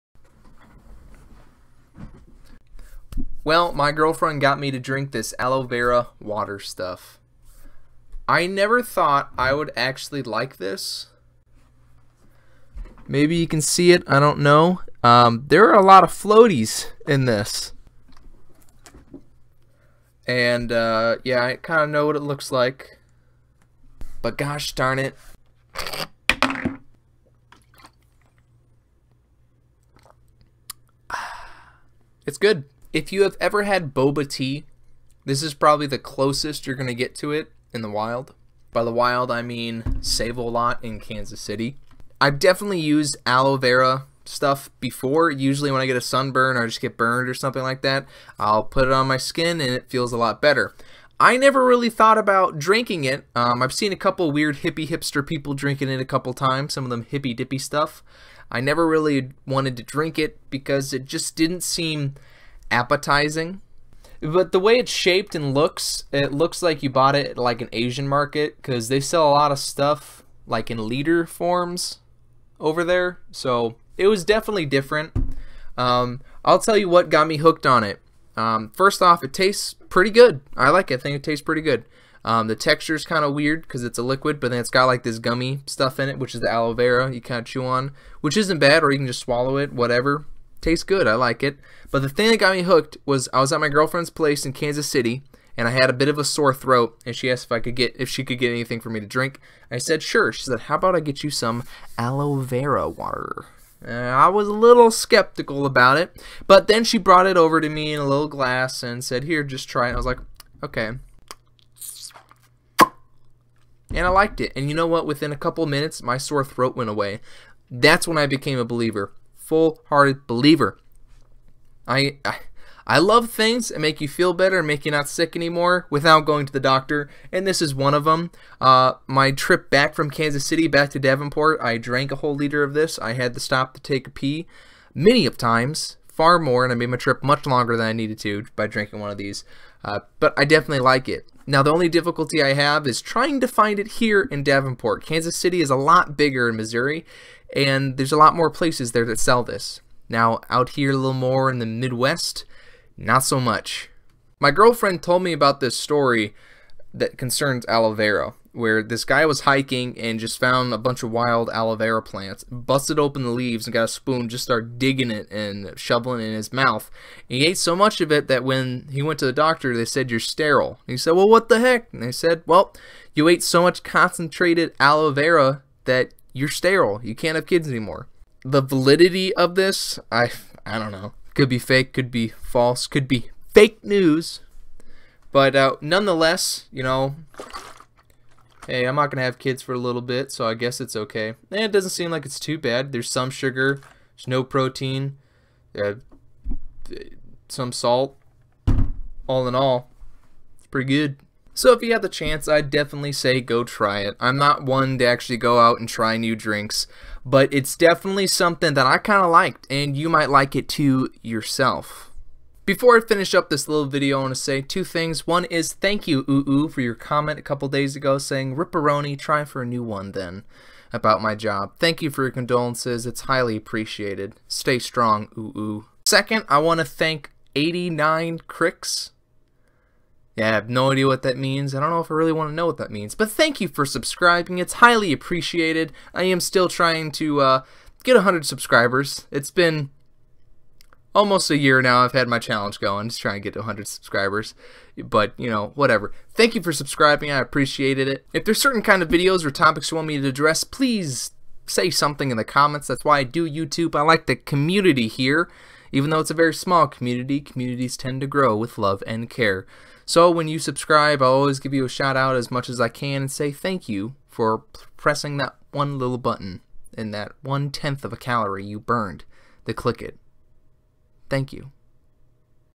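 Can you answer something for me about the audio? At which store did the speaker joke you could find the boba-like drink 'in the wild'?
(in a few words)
Save-A-Lot.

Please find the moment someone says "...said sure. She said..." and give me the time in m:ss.
1:39.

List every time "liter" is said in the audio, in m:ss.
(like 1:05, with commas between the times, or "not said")
1:10, 2:12.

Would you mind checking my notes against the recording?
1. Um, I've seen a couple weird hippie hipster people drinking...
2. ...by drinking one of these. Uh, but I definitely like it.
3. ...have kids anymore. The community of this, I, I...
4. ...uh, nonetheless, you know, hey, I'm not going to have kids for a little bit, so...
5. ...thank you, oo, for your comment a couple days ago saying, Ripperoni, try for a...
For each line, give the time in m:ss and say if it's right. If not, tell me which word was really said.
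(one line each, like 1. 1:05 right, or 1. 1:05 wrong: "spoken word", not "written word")
1. 0:53 right
2. 2:18 right
3. 2:57 wrong: "validity", not "community"
4. 3:05 right
5. 3:35 right.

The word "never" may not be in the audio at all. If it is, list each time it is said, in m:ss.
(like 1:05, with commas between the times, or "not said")
0:08, 0:51, 0:58.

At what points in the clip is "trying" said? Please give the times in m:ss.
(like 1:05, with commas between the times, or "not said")
2:23, 3:56, 4:03.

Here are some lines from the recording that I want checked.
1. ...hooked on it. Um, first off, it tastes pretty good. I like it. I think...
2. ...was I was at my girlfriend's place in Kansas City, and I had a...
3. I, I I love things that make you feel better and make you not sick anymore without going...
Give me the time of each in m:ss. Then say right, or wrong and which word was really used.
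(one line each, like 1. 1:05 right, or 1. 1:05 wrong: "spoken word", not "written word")
1. 1:17 right
2. 1:33 right
3. 2:01 right.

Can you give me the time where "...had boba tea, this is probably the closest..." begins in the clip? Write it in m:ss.
0:33.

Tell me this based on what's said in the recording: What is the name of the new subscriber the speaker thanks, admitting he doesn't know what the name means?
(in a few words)
89 Cricks.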